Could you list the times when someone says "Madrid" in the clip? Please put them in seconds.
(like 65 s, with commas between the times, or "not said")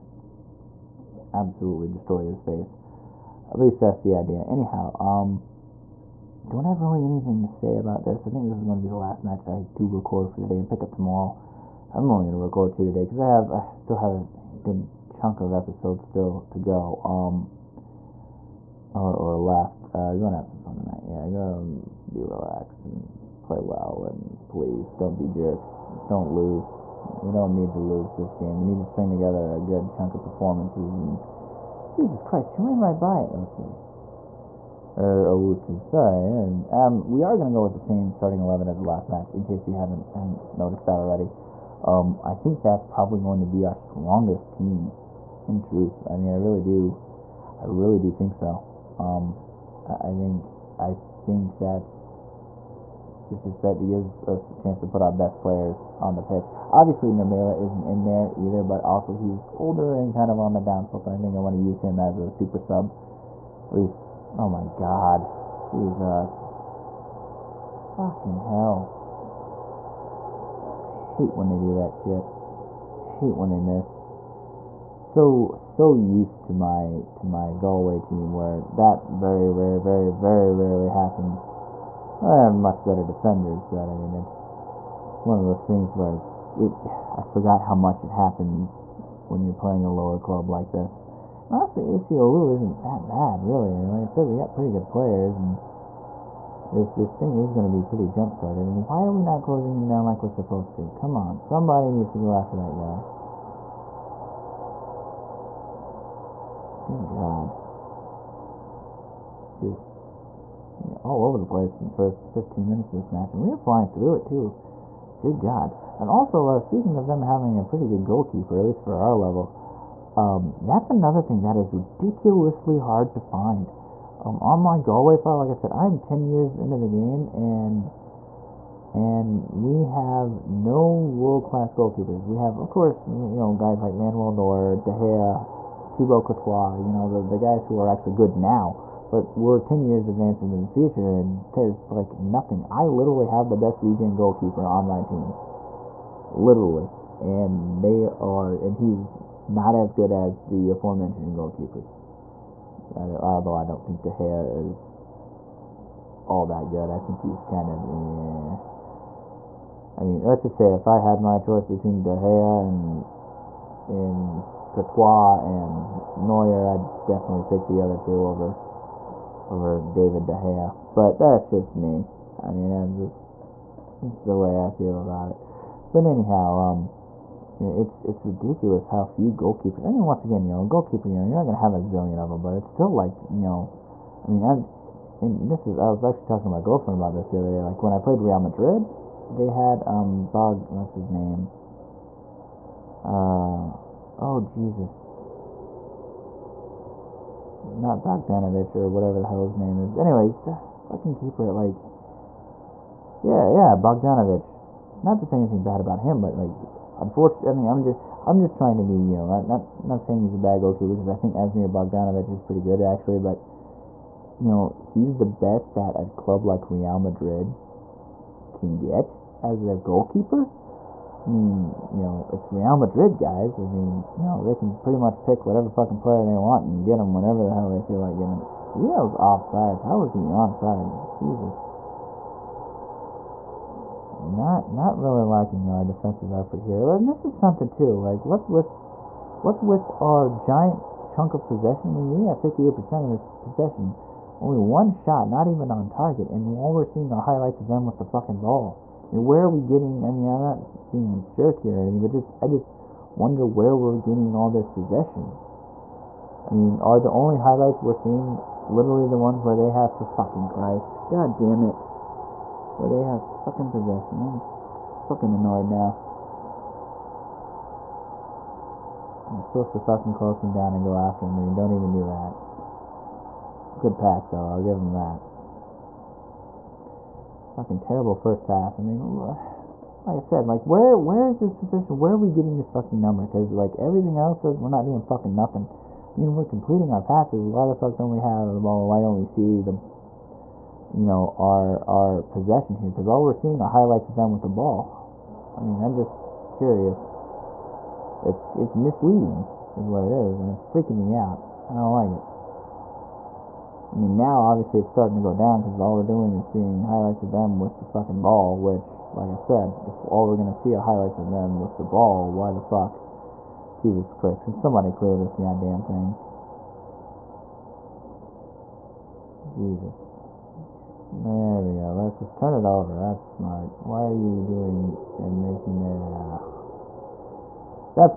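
188 s, 216 s, 222 s.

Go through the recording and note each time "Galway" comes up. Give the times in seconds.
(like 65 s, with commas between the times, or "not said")
77 s, 124 s.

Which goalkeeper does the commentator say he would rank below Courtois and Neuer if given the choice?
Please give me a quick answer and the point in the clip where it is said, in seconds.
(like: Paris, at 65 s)
David De Gea, at 169 s.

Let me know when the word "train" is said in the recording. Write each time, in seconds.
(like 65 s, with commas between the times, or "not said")
not said.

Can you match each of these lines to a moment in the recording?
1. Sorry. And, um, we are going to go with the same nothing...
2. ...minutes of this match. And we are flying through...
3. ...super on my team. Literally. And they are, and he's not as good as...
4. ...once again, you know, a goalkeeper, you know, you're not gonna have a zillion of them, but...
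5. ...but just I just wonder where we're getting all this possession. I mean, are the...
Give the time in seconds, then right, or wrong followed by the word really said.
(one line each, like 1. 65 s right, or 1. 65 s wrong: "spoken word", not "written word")
1. 35 s wrong: "starting", not "nothing"
2. 112 s right
3. 144 s wrong: "goalkeeper", not "super"
4. 180 s right
5. 252 s right.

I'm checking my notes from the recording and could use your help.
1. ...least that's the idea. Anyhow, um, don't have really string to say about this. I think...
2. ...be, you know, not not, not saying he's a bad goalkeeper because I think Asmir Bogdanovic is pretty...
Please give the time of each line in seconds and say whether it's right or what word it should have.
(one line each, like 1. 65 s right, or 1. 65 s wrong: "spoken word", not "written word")
1. 3 s wrong: "anything", not "string"
2. 208 s right.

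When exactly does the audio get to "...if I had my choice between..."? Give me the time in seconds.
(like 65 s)
160 s.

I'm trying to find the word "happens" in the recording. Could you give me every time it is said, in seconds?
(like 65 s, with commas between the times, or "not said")
80 s, 88 s.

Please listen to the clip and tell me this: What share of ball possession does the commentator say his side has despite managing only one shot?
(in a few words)
58%.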